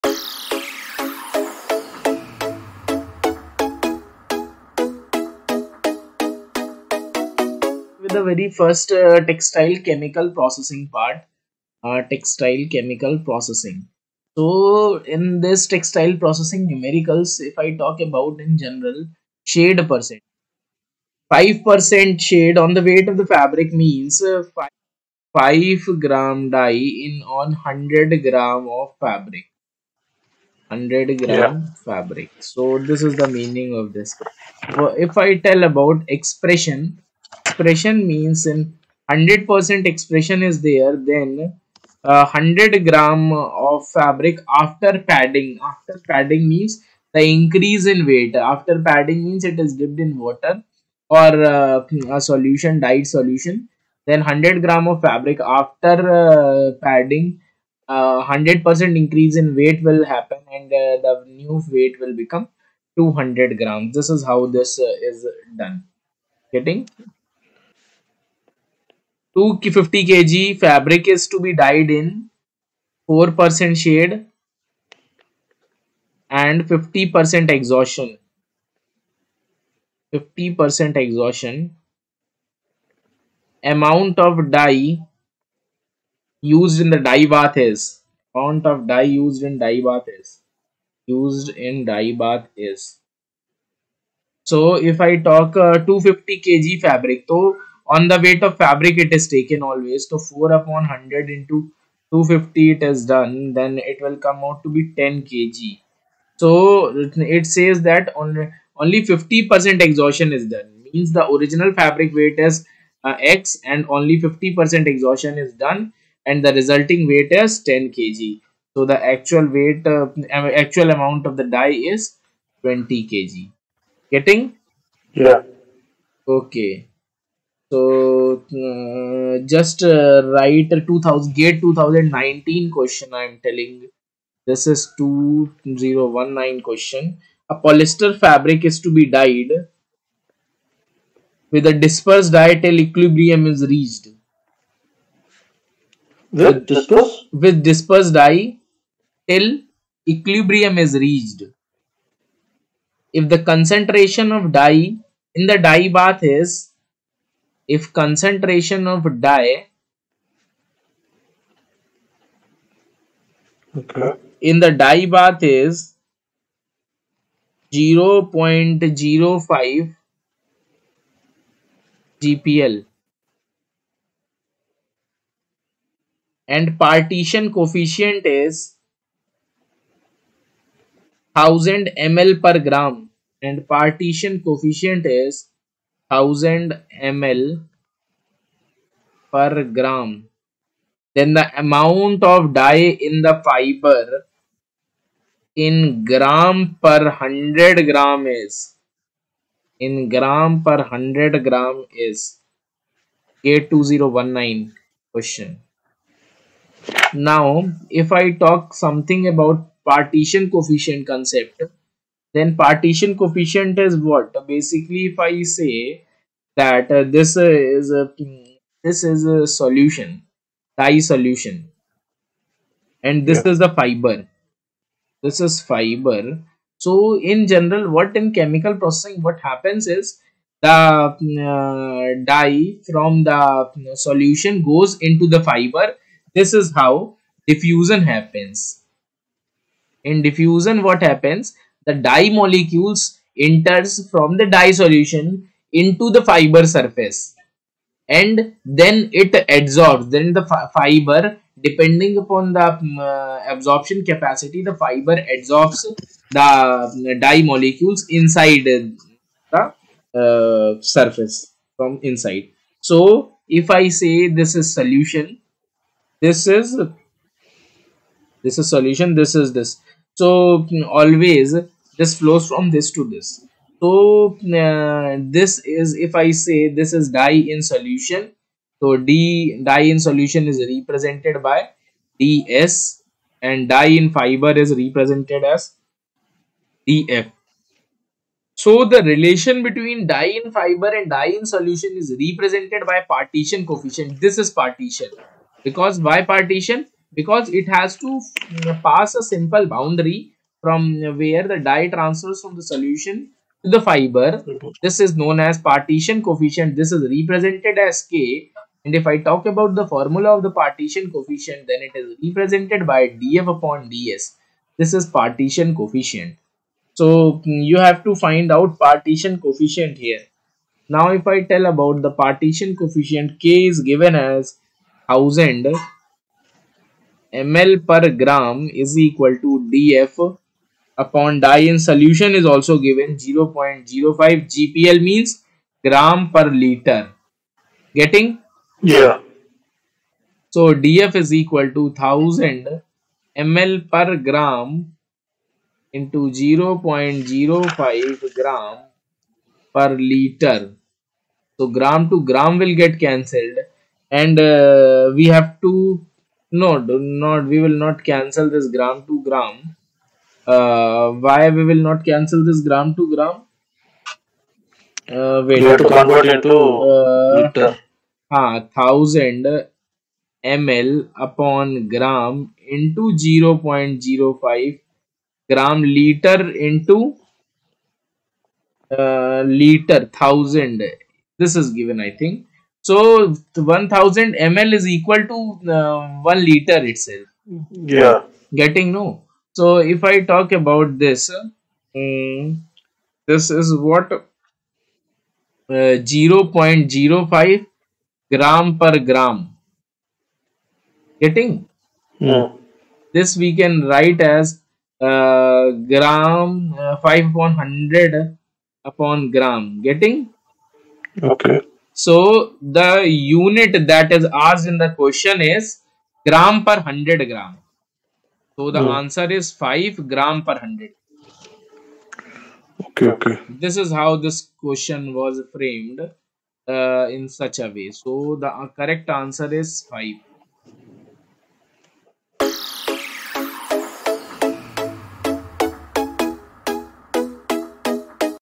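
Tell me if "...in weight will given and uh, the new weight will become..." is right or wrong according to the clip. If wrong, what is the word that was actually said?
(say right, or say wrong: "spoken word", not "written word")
wrong: "happen", not "given".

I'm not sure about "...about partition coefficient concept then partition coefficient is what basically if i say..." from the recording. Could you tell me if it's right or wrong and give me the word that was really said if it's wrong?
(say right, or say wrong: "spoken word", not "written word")
right.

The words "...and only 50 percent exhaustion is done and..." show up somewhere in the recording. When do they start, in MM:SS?
01:53.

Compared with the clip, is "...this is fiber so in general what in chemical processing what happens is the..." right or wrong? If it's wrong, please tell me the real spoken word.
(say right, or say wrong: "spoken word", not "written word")
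right.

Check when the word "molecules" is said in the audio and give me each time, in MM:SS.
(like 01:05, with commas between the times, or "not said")
04:02, 04:17.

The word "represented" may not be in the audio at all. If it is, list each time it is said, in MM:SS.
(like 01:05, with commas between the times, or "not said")
04:40, 04:44, 04:52, 05:07, 05:12.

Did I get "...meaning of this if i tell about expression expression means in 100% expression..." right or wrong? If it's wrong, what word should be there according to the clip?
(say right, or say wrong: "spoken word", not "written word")
right.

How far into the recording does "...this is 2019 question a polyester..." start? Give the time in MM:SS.
02:14.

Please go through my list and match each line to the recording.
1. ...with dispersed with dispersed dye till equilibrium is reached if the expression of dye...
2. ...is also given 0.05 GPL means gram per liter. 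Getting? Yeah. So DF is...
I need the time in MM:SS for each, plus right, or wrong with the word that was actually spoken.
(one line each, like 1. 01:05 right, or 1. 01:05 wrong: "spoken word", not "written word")
1. 02:26 wrong: "concentration", not "expression"
2. 05:32 right.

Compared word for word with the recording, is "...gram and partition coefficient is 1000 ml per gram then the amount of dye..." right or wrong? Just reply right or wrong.
right.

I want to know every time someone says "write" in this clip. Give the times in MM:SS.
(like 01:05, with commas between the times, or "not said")
02:10, 06:43.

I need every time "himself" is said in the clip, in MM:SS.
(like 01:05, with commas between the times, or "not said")
not said.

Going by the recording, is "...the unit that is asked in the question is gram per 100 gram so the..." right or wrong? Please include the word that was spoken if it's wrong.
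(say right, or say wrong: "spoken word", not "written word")
right.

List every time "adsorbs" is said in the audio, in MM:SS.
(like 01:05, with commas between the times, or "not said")
04:09, 04:15.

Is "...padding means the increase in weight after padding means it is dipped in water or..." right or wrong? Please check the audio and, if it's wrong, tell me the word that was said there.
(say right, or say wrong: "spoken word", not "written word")
right.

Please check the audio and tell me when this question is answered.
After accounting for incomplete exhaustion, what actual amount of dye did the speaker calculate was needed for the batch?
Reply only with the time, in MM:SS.
02:02.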